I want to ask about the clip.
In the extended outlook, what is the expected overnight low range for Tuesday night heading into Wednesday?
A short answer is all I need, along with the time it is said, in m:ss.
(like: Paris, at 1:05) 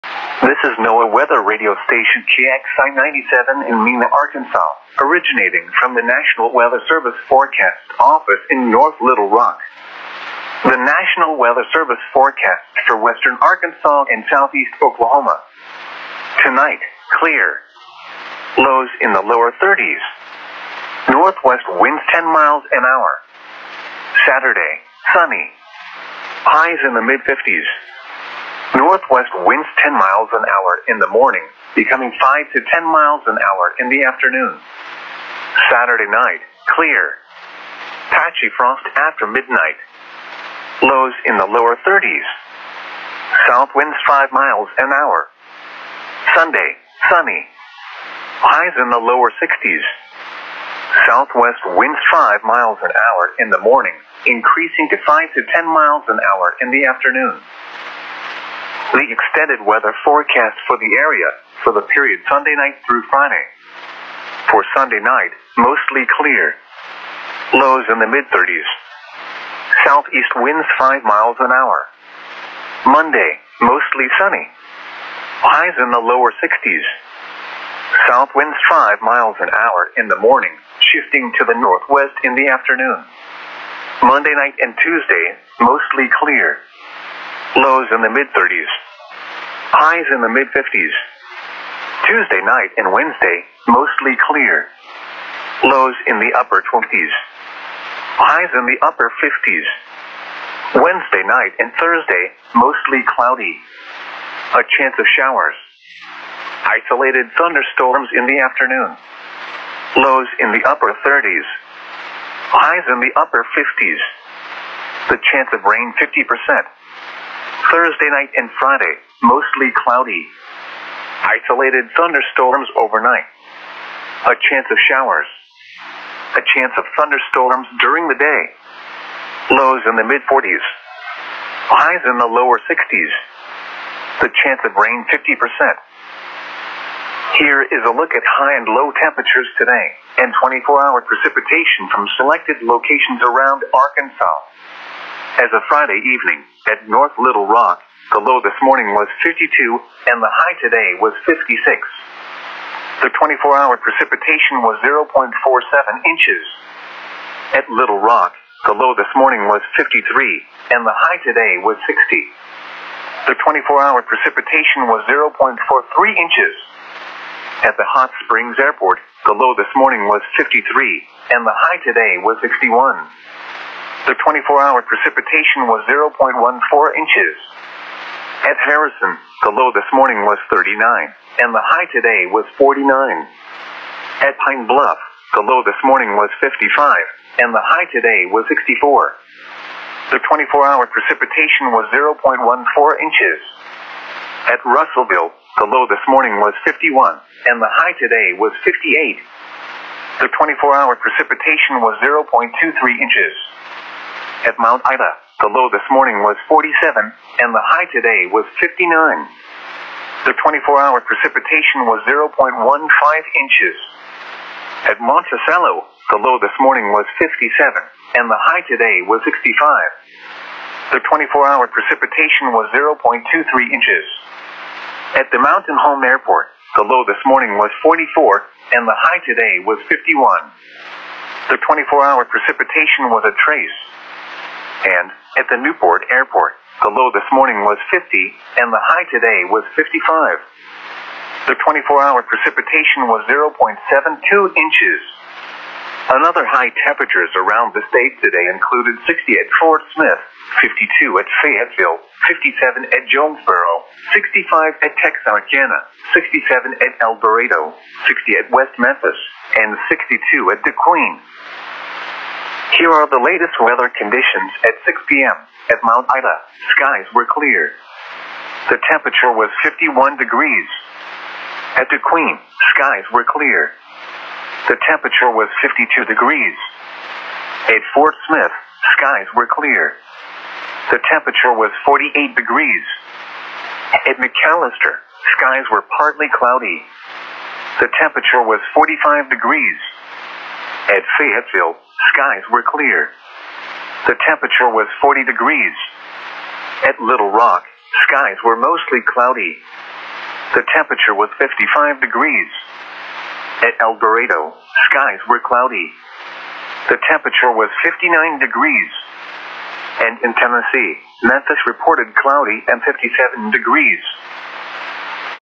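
Upper 20s, at 1:36.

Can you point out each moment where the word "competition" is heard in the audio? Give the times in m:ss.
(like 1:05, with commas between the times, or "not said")
not said.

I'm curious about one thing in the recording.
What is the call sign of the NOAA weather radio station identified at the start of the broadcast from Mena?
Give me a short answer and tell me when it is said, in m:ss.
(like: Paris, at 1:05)
KXI 97, at 0:02.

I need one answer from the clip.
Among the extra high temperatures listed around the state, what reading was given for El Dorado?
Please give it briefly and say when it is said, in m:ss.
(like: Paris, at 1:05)
67, at 4:16.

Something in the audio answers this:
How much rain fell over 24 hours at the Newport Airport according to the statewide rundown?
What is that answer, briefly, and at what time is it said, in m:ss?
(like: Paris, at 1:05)
0.72 inches, at 4:03.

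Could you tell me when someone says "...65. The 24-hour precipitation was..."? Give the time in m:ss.
3:39.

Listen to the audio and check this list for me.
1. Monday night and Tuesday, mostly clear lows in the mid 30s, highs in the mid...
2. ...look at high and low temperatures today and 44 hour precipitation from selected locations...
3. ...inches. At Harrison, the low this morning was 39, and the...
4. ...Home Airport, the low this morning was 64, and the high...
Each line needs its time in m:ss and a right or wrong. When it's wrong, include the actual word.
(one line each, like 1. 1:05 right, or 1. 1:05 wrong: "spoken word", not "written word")
1. 1:24 right
2. 2:17 wrong: "24", not "44"
3. 2:56 right
4. 3:45 wrong: "44", not "64".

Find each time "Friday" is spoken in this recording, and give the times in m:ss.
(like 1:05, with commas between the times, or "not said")
1:03, 1:58, 2:25.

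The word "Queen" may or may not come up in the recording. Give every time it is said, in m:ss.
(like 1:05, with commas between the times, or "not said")
4:20, 4:31.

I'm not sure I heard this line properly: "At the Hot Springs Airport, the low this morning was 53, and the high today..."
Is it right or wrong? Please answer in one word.
right.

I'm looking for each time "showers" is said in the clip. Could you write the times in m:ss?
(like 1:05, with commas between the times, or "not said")
1:45, 2:04.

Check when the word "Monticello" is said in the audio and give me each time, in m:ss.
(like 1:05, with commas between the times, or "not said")
3:34.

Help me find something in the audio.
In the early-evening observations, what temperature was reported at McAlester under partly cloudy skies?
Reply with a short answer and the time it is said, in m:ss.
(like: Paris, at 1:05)
45 degrees, at 4:48.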